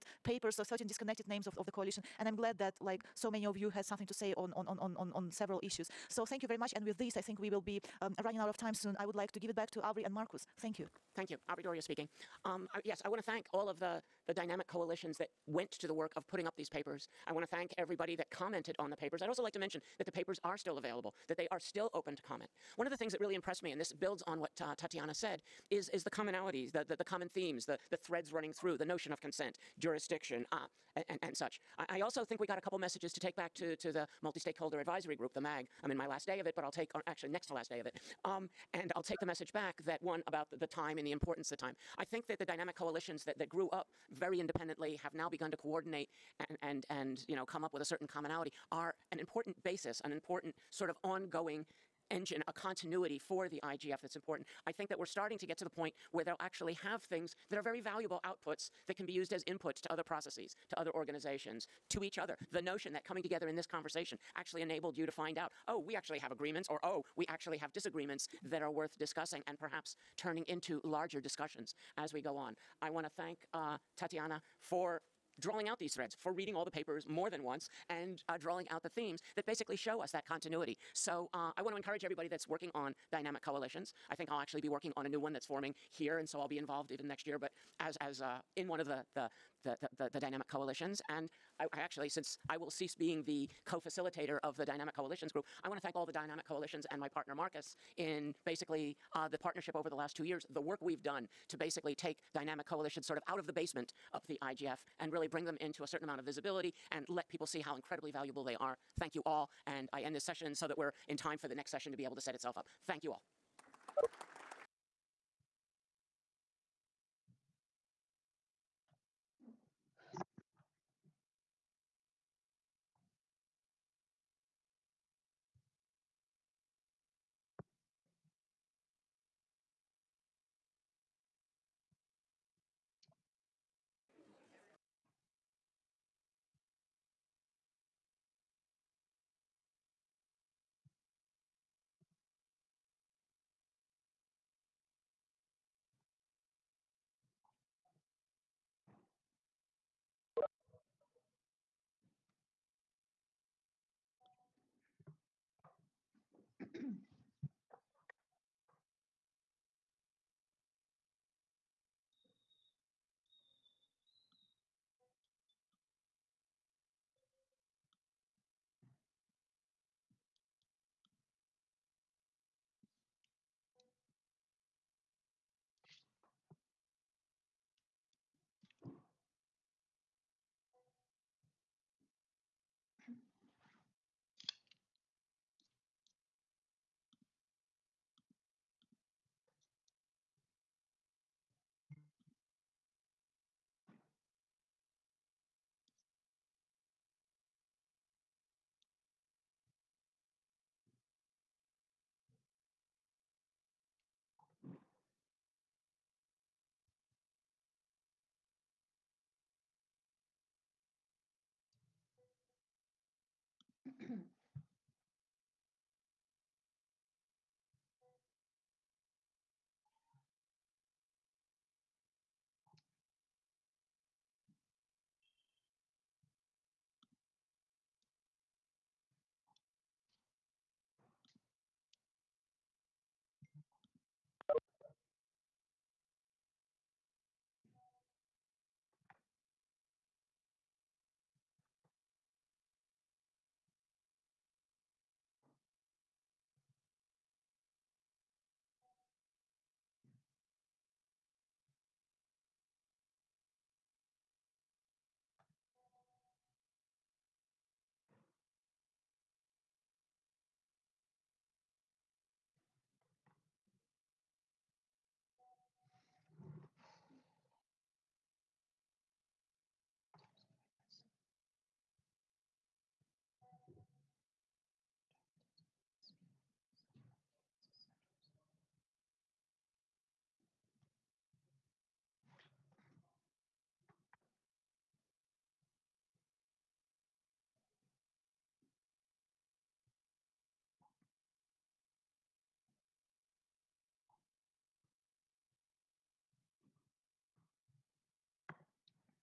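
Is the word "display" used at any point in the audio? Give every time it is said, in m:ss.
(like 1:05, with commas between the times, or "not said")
not said.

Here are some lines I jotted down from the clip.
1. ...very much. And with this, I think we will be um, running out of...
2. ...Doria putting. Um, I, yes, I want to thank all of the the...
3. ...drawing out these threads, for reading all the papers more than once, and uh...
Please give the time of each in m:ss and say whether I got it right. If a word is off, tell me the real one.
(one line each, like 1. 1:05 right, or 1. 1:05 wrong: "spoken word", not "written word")
1. 0:06 right
2. 0:11 wrong: "speaking", not "putting"
3. 1:15 right.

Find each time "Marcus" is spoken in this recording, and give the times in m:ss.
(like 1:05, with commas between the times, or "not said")
0:10, 1:37.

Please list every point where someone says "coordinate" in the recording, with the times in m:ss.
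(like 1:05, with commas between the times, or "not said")
0:45.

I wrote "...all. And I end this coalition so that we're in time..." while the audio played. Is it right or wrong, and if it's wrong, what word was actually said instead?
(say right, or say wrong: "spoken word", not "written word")
wrong: "session", not "coalition".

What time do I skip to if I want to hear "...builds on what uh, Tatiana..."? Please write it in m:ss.
0:23.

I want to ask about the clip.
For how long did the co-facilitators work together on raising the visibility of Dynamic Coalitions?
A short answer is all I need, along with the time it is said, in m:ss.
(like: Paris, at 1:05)
2 years, at 1:40.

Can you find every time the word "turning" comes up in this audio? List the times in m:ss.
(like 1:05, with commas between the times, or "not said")
1:10.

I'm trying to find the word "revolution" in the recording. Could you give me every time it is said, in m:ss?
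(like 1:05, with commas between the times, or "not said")
not said.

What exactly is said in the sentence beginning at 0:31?
I, also think we got a couple messages to take back to, to the multi-stakeholder advisory group, the MAG.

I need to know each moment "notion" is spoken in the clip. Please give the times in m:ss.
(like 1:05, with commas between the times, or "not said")
0:28, 1:02.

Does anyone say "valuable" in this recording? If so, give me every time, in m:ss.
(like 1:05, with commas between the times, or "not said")
0:57, 1:48.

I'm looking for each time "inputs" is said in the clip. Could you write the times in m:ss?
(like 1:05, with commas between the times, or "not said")
0:59.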